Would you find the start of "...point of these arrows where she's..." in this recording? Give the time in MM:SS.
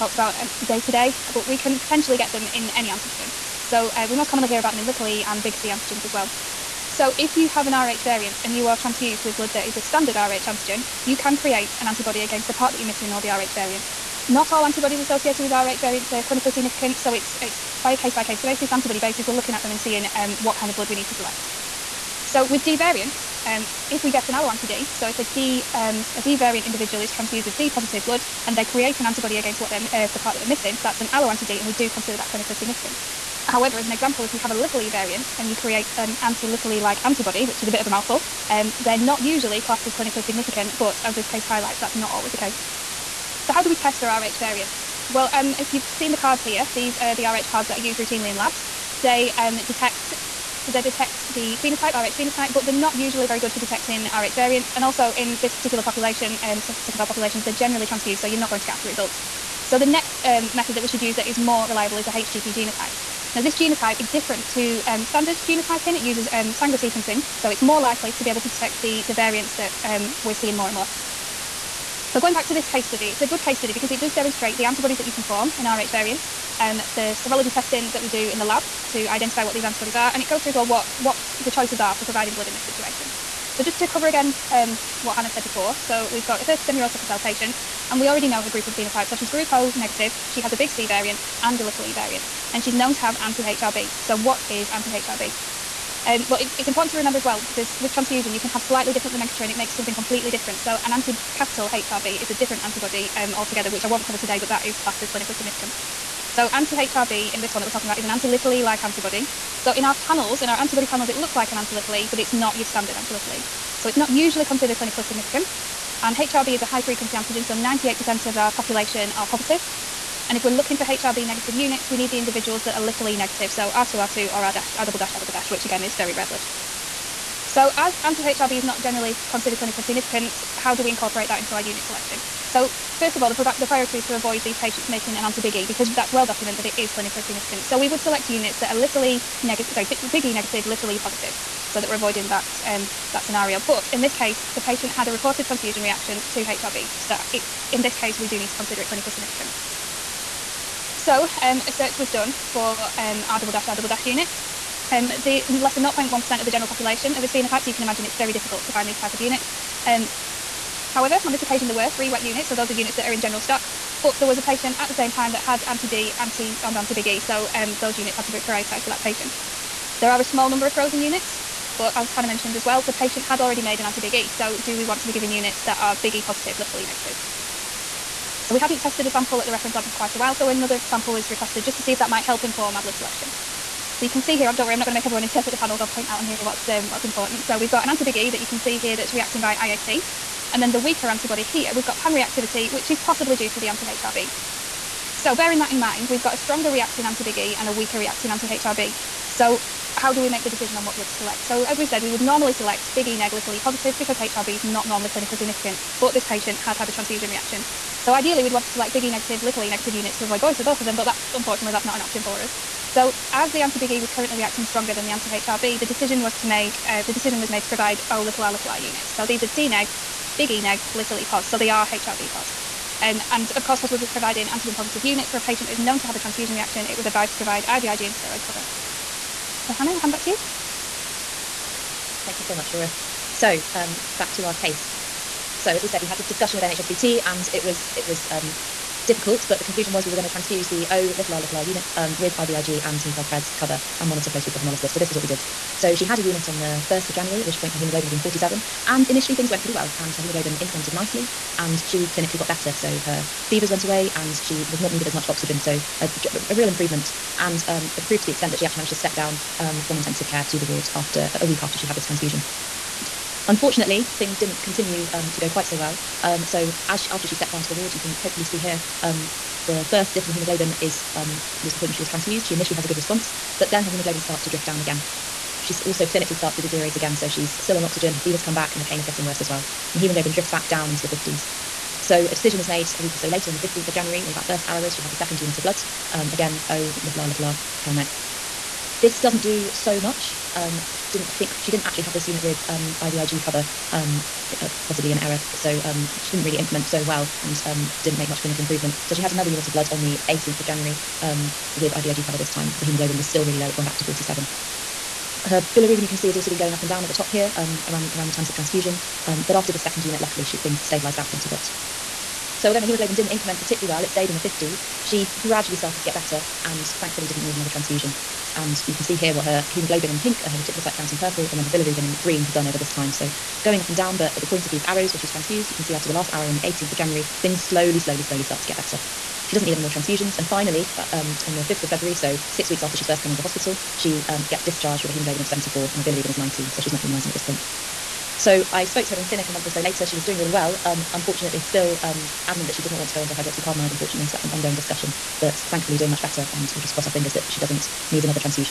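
05:24.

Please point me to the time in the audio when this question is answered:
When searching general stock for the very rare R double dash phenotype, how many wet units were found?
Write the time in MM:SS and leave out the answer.
02:41.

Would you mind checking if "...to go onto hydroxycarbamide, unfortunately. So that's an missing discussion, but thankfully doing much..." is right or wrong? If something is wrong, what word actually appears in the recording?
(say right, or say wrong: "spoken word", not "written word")
wrong: "ongoing", not "missing".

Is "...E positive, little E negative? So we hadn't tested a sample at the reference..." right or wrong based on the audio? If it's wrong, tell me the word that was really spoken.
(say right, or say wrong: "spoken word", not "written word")
right.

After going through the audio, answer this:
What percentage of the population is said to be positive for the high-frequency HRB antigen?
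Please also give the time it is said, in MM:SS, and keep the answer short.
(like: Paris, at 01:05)
98%, at 01:57.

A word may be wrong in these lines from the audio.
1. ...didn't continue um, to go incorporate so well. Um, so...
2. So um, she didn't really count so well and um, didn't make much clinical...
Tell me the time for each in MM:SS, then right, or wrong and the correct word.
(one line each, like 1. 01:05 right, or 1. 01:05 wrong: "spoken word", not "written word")
1. 04:24 wrong: "quite", not "incorporate"
2. 04:55 wrong: "increment", not "count".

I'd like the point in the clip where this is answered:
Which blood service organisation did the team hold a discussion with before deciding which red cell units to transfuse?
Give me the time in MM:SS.
03:56.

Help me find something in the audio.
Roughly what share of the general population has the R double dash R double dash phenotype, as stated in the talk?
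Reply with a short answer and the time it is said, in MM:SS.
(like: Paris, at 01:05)
Less than 0.1%, at 02:35.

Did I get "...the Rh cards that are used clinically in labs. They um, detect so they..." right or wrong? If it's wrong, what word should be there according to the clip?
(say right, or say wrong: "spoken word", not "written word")
wrong: "routinely", not "clinically".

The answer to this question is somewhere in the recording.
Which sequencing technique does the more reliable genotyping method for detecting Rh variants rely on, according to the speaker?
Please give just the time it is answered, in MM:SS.
01:06.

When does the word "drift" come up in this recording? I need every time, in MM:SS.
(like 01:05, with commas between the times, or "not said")
04:34, 04:40.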